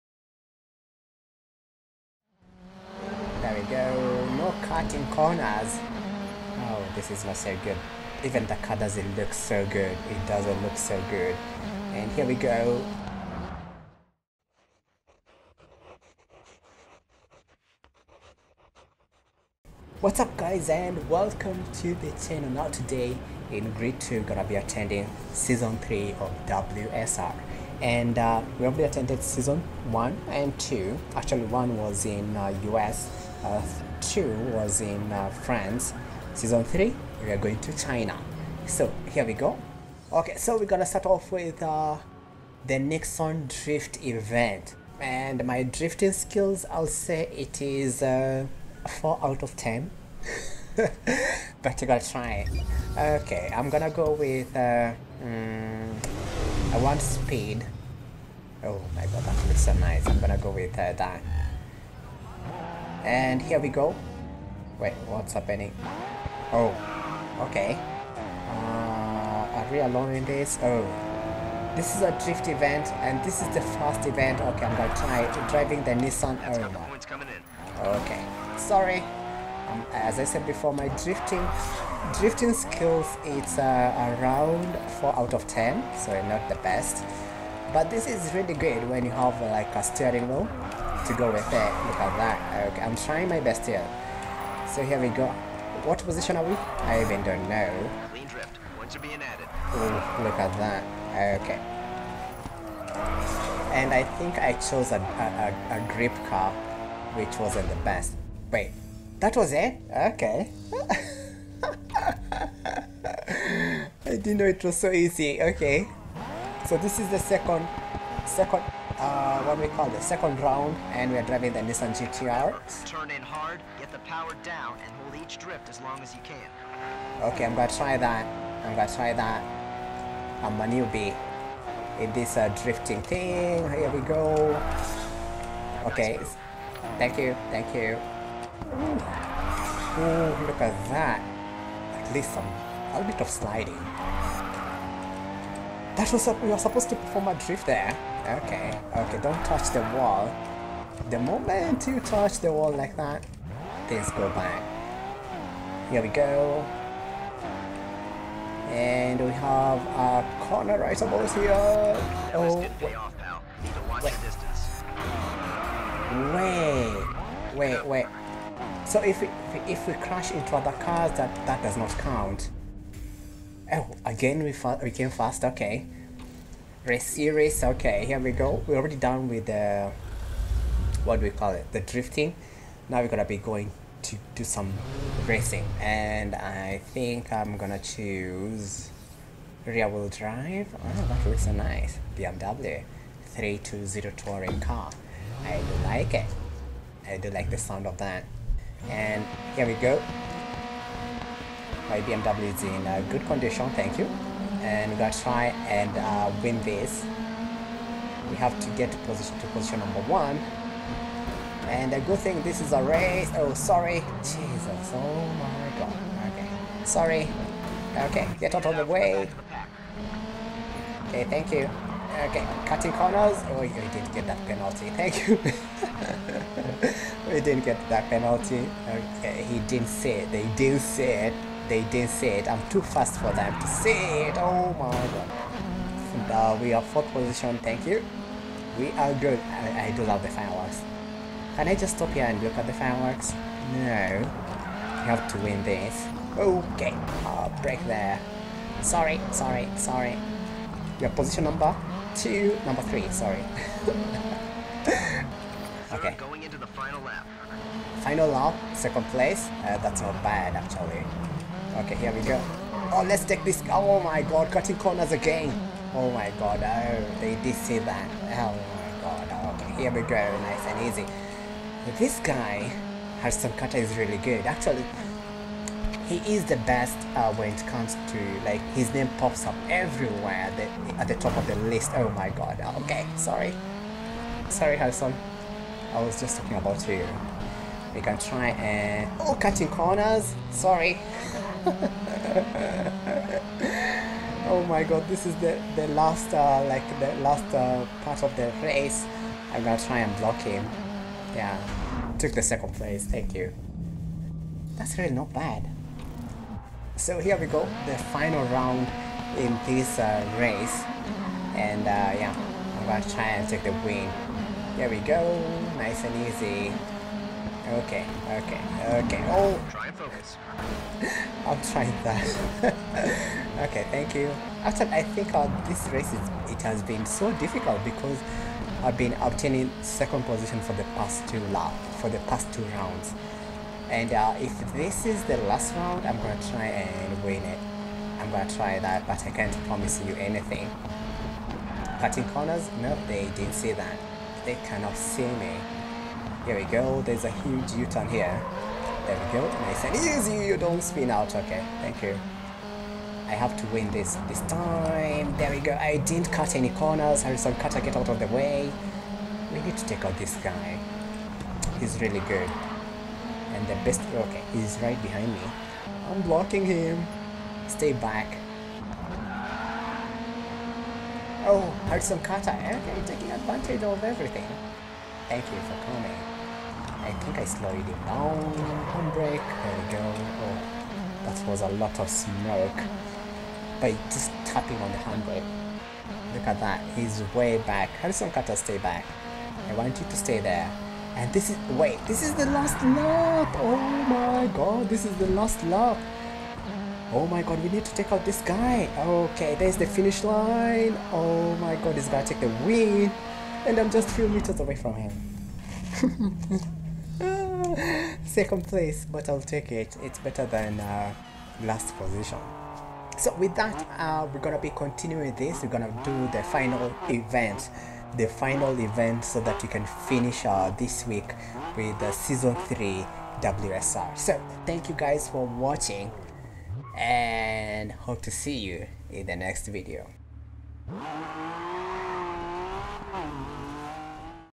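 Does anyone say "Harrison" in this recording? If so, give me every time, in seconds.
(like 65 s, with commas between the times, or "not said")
273 s, 284 s, 357 s, 371 s, 388 s.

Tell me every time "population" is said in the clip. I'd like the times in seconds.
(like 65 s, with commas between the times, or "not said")
not said.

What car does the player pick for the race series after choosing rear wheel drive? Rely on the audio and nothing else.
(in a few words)
BMW 320 touring car.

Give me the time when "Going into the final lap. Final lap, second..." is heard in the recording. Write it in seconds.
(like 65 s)
256 s.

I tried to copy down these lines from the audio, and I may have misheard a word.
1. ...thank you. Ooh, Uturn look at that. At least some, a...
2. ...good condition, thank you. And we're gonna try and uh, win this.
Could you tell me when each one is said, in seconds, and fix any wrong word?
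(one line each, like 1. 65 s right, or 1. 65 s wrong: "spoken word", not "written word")
1. 137 s wrong: "Ooh", not "Uturn"
2. 203 s right.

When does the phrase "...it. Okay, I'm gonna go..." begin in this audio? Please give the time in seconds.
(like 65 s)
52 s.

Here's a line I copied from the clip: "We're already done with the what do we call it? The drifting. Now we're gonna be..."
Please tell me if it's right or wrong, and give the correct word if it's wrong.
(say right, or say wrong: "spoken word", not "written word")
right.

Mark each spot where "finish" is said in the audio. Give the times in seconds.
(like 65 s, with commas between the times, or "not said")
399 s, 419 s.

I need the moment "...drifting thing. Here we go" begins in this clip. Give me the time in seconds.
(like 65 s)
132 s.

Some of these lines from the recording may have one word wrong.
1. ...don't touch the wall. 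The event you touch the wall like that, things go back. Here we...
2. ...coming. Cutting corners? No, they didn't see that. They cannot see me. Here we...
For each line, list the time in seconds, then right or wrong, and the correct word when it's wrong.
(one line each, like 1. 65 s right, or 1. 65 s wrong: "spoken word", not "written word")
1. 149 s wrong: "moment", not "event"
2. 340 s wrong: "anything", not "coming".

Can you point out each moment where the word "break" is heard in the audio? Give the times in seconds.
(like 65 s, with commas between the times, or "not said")
247 s.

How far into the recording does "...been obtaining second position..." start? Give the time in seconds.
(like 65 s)
328 s.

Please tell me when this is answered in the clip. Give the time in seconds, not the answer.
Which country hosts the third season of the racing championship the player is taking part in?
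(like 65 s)
37 s.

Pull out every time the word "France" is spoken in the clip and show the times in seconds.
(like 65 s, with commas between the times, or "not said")
35 s.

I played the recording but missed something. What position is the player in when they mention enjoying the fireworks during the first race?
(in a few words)
Fourth.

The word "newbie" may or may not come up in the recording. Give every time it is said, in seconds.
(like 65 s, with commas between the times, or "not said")
130 s.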